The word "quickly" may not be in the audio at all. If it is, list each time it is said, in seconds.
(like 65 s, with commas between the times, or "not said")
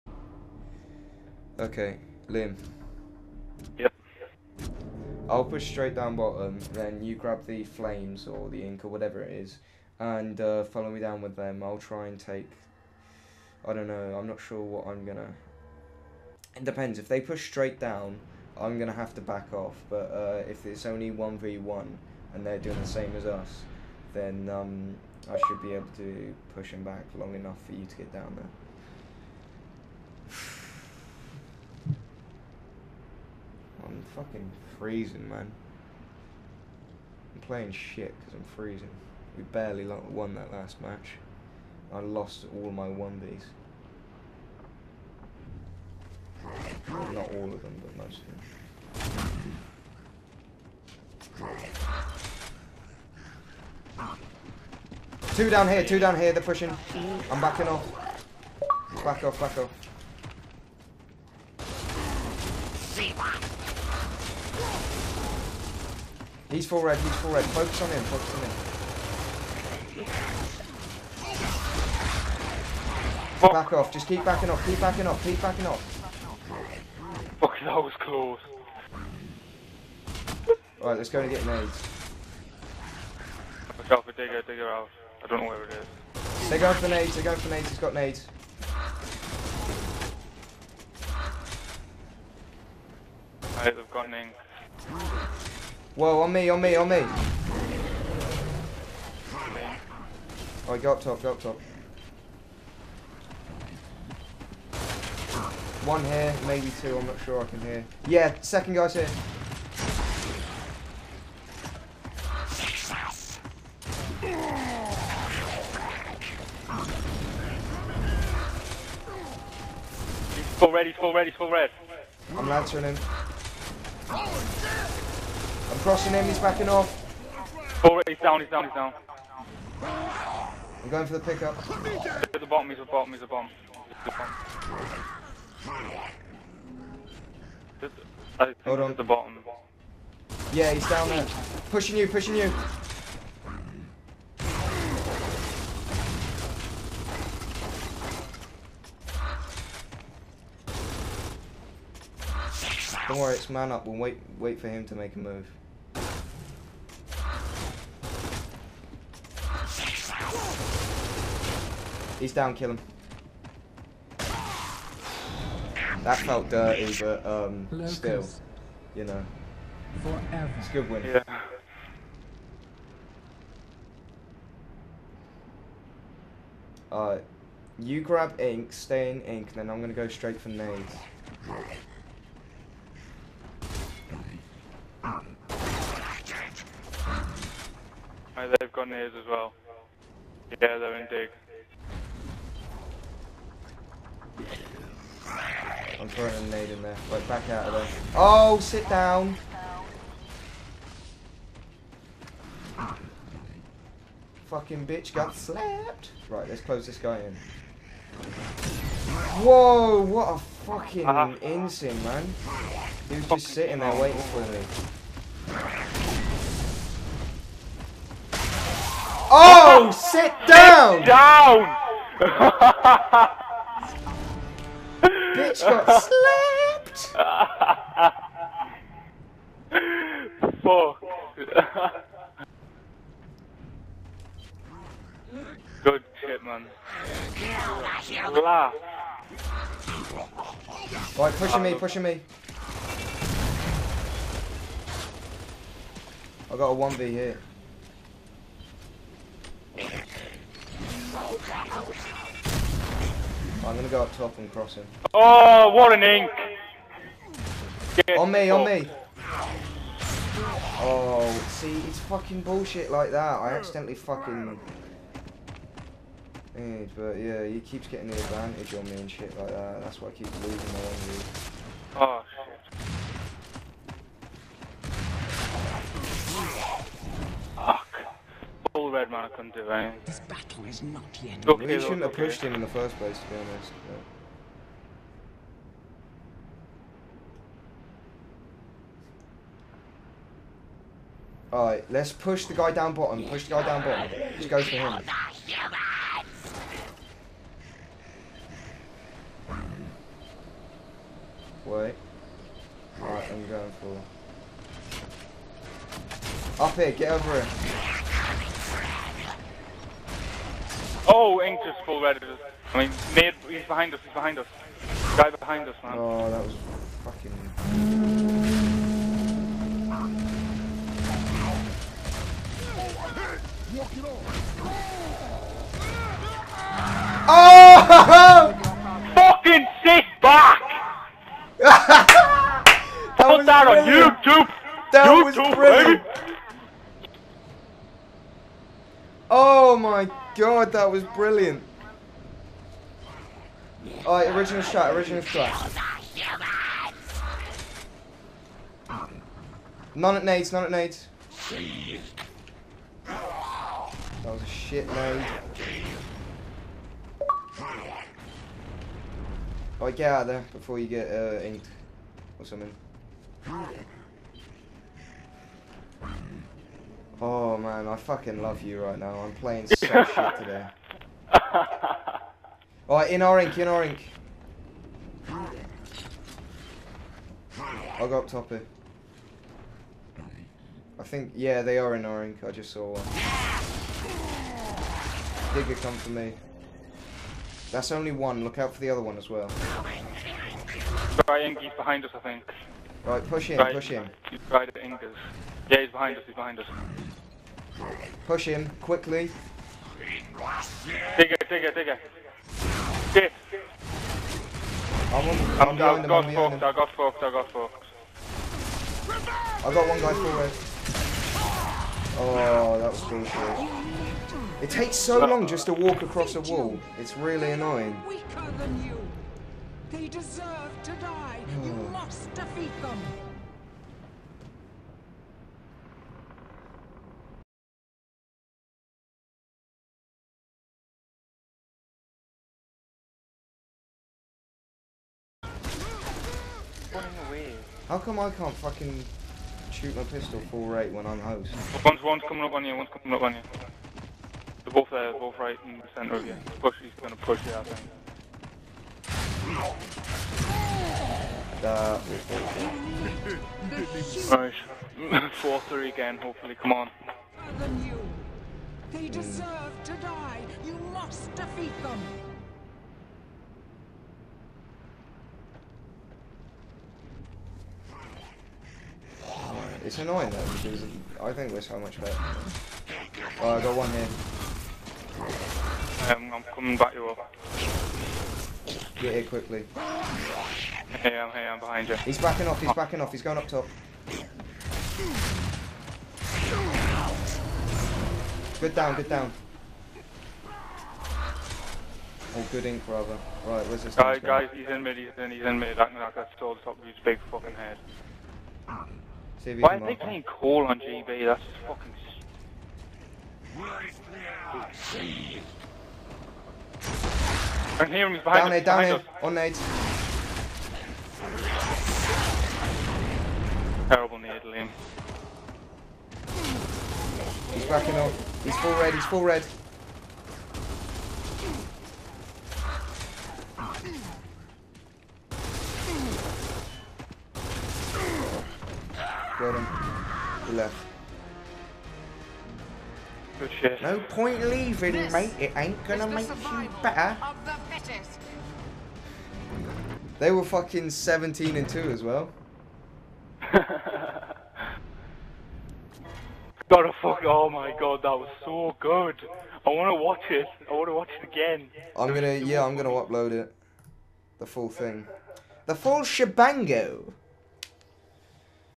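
398 s, 479 s.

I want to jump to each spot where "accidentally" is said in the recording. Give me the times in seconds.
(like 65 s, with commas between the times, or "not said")
263 s.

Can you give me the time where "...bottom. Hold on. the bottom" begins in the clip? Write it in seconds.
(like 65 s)
138 s.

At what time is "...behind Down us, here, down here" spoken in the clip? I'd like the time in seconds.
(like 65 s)
508 s.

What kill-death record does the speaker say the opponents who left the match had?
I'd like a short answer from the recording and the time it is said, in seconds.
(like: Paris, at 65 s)
17 and 2, at 540 s.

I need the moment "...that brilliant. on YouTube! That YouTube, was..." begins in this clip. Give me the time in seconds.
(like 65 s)
333 s.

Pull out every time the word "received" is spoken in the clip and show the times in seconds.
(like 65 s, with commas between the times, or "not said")
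not said.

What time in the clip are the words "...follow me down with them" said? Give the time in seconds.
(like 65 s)
10 s.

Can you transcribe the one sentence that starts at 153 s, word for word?
We'll wait, wait for him to make a move.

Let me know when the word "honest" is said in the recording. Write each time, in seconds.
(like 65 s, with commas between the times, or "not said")
283 s.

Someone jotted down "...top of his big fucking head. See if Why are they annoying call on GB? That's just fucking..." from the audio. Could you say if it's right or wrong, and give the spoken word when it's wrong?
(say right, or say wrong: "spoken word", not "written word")
wrong: "playing", not "annoying".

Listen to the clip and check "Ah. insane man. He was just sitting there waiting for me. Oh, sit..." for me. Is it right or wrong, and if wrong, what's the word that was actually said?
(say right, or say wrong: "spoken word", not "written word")
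right.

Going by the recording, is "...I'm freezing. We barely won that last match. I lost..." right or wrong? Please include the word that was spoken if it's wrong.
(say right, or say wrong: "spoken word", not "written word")
right.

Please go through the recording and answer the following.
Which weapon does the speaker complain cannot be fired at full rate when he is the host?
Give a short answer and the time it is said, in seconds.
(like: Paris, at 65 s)
pistol, at 440 s.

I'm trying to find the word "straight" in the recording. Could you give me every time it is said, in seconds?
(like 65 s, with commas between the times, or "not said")
5 s, 17 s, 180 s.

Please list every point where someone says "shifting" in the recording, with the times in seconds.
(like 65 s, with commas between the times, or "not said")
not said.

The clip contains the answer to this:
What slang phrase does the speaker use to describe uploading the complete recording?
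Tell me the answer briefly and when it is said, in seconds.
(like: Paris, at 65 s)
The full shebango, at 555 s.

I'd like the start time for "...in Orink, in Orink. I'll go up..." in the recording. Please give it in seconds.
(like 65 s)
373 s.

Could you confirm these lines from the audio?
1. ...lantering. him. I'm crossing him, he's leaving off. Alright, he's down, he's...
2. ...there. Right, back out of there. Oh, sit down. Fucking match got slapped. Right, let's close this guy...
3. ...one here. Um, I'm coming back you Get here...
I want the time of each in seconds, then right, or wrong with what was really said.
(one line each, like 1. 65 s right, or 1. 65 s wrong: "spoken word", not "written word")
1. 122 s wrong: "backing", not "leaving"
2. 196 s wrong: "bitch", not "match"
3. 473 s right.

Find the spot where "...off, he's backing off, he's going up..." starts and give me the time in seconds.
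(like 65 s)
482 s.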